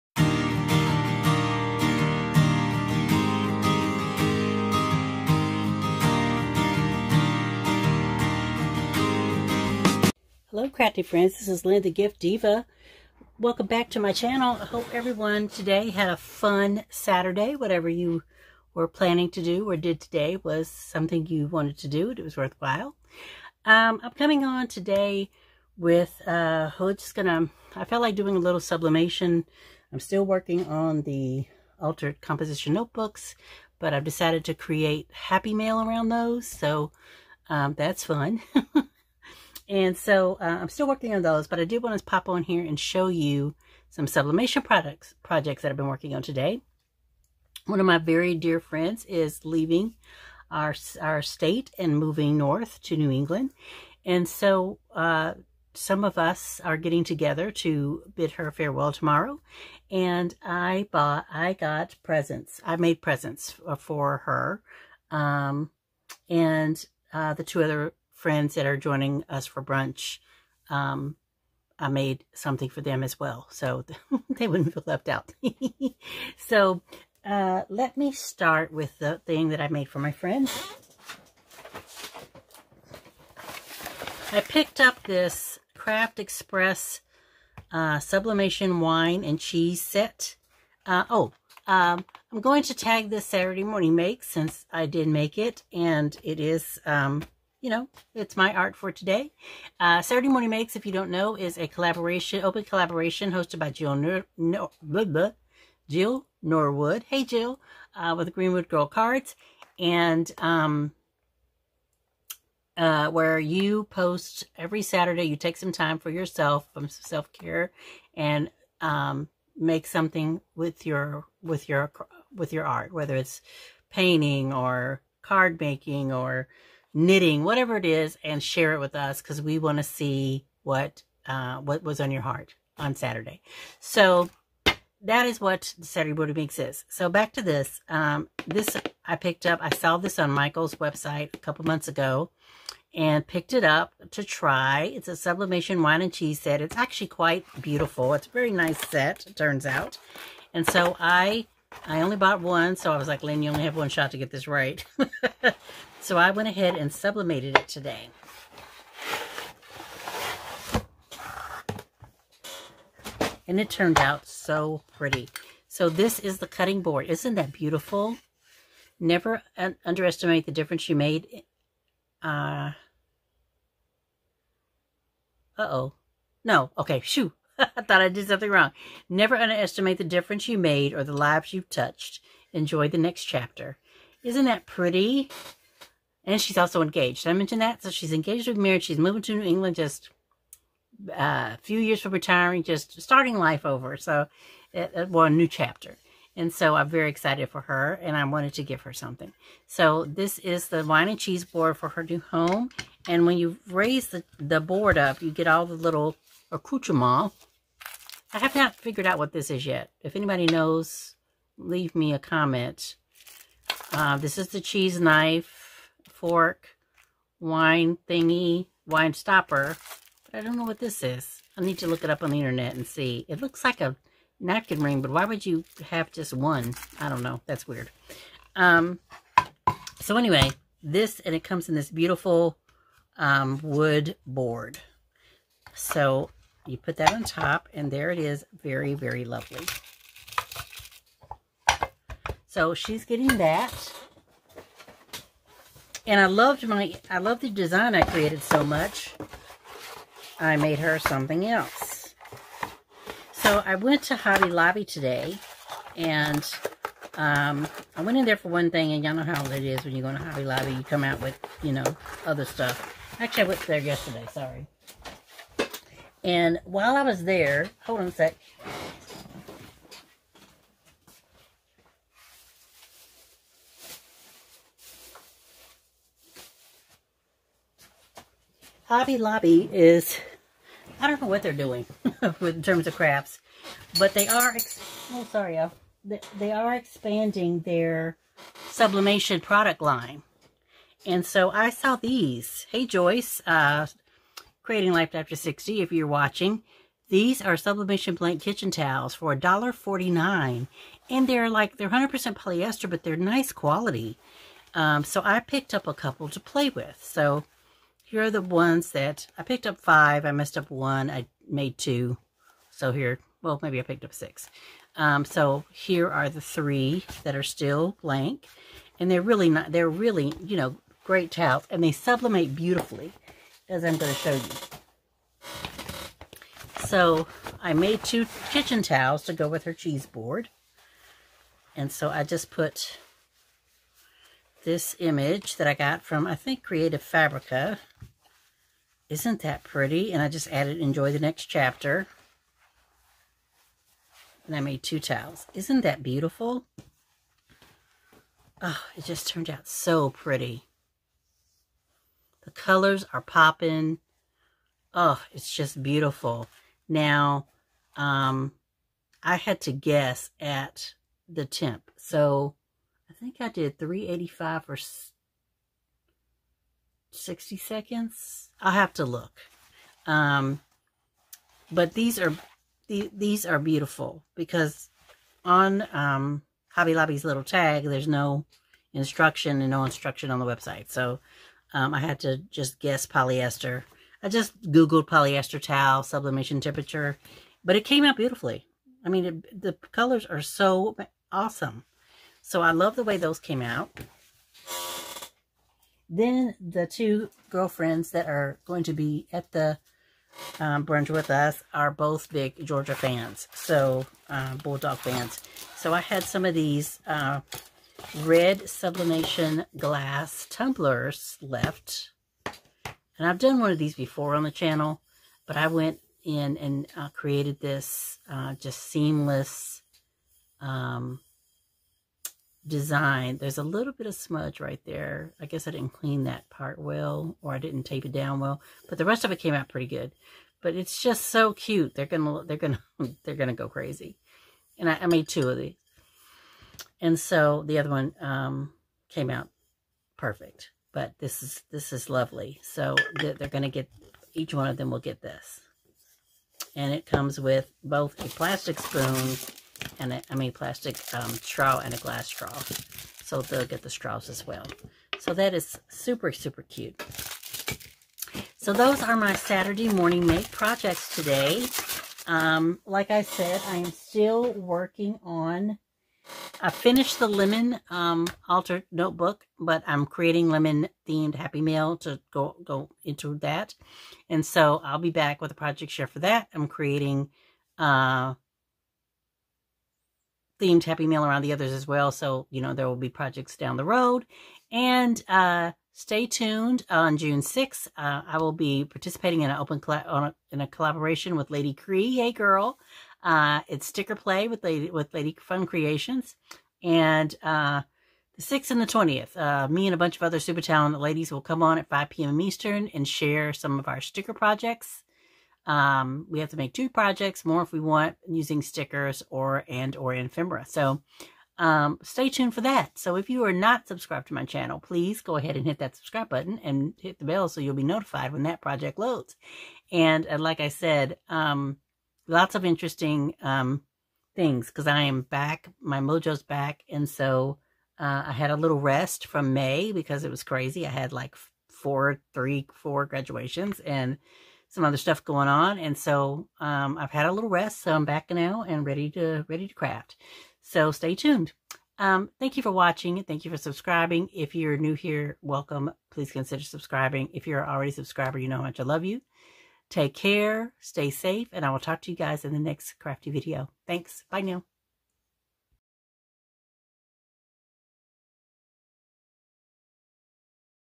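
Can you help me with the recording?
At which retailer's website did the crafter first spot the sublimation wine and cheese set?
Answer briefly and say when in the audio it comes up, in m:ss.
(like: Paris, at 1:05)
Michael's, at 2:20.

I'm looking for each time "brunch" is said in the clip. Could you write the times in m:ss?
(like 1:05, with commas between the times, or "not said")
1:09, 6:40.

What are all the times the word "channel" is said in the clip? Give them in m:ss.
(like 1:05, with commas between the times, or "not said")
0:14, 6:54, 8:34.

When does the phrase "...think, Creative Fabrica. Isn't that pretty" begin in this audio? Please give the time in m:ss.
5:36.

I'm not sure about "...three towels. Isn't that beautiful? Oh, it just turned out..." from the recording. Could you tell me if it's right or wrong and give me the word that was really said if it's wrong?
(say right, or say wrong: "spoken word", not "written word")
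wrong: "two", not "three".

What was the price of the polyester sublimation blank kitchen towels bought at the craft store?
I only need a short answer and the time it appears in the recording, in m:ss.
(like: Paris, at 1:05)
$1.49, at 4:59.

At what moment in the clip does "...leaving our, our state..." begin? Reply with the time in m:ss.
0:49.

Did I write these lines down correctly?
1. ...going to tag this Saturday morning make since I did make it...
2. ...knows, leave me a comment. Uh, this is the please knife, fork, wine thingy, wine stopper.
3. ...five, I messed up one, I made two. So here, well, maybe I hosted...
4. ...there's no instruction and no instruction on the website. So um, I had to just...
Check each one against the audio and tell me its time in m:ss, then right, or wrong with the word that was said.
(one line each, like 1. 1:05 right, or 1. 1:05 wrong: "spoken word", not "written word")
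1. 1:32 right
2. 3:30 wrong: "cheese", not "please"
3. 5:09 wrong: "picked", not "hosted"
4. 6:17 right.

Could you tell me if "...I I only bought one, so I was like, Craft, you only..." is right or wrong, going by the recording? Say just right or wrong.
wrong.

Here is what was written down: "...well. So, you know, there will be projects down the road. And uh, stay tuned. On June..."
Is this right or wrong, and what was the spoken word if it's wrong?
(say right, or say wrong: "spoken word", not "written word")
right.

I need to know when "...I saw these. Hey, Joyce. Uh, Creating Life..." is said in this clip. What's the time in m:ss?
4:51.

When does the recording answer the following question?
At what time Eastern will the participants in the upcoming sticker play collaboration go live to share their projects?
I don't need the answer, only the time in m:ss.
8:21.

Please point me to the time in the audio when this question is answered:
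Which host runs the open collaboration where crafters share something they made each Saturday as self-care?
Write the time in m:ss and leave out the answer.
1:45.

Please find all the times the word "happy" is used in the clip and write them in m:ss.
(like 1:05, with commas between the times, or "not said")
0:35, 7:51, 8:00.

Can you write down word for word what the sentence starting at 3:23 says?
And when you raise the, the board up, you get all the little accoutrements.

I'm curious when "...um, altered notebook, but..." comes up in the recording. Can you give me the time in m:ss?
7:47.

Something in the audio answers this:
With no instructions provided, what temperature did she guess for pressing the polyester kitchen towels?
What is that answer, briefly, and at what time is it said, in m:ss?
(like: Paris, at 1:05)
385, at 6:03.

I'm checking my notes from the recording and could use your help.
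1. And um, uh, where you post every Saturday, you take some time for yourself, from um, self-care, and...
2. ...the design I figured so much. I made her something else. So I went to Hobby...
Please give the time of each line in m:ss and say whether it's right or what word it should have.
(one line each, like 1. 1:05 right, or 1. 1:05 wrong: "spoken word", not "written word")
1. 1:49 right
2. 4:07 wrong: "created", not "figured".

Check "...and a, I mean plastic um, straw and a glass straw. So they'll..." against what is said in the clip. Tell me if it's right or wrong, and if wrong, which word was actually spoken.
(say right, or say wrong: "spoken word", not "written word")
right.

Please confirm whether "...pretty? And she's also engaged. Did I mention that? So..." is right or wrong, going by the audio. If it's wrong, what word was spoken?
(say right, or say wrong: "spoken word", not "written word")
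right.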